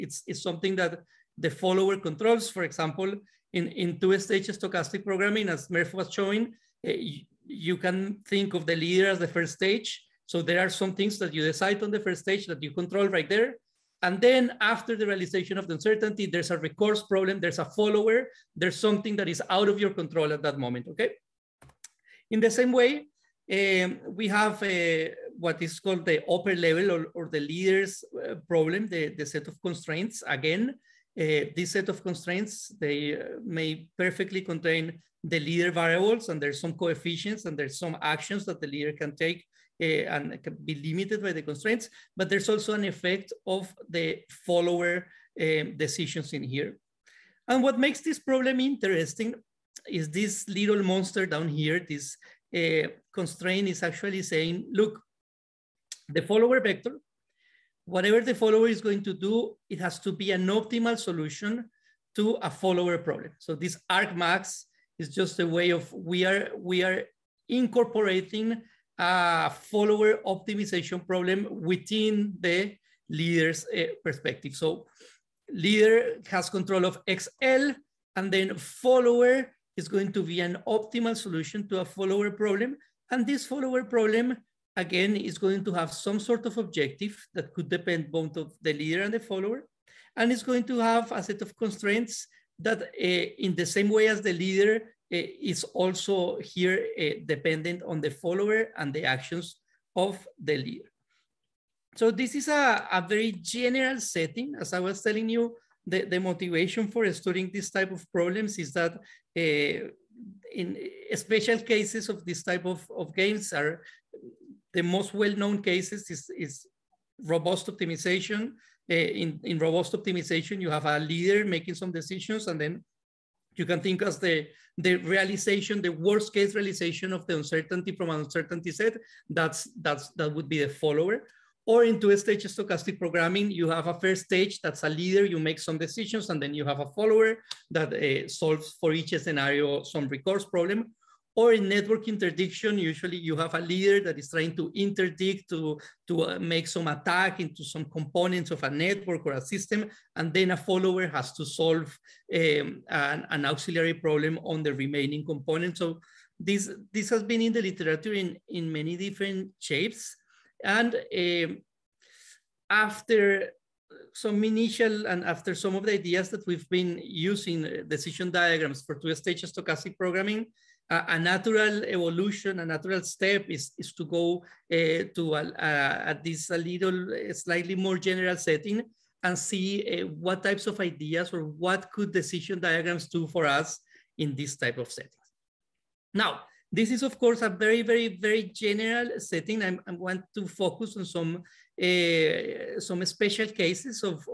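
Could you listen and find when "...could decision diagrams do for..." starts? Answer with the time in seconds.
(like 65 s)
181 s.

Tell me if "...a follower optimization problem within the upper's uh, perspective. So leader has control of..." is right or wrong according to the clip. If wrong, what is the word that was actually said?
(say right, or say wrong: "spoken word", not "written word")
wrong: "leader", not "upper".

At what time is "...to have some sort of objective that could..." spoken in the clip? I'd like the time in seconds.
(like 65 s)
85 s.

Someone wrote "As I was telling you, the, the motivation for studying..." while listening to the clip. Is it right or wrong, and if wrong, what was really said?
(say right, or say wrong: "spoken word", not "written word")
right.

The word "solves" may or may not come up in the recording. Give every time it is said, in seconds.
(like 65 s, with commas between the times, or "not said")
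138 s, 151 s.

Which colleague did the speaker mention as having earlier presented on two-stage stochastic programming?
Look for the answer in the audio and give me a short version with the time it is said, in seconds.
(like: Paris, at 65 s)
Merve, at 5 s.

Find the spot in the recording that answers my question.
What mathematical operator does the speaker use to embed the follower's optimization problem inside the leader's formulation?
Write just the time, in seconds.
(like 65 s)
63 s.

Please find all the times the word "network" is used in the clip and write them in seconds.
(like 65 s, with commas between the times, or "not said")
141 s, 148 s.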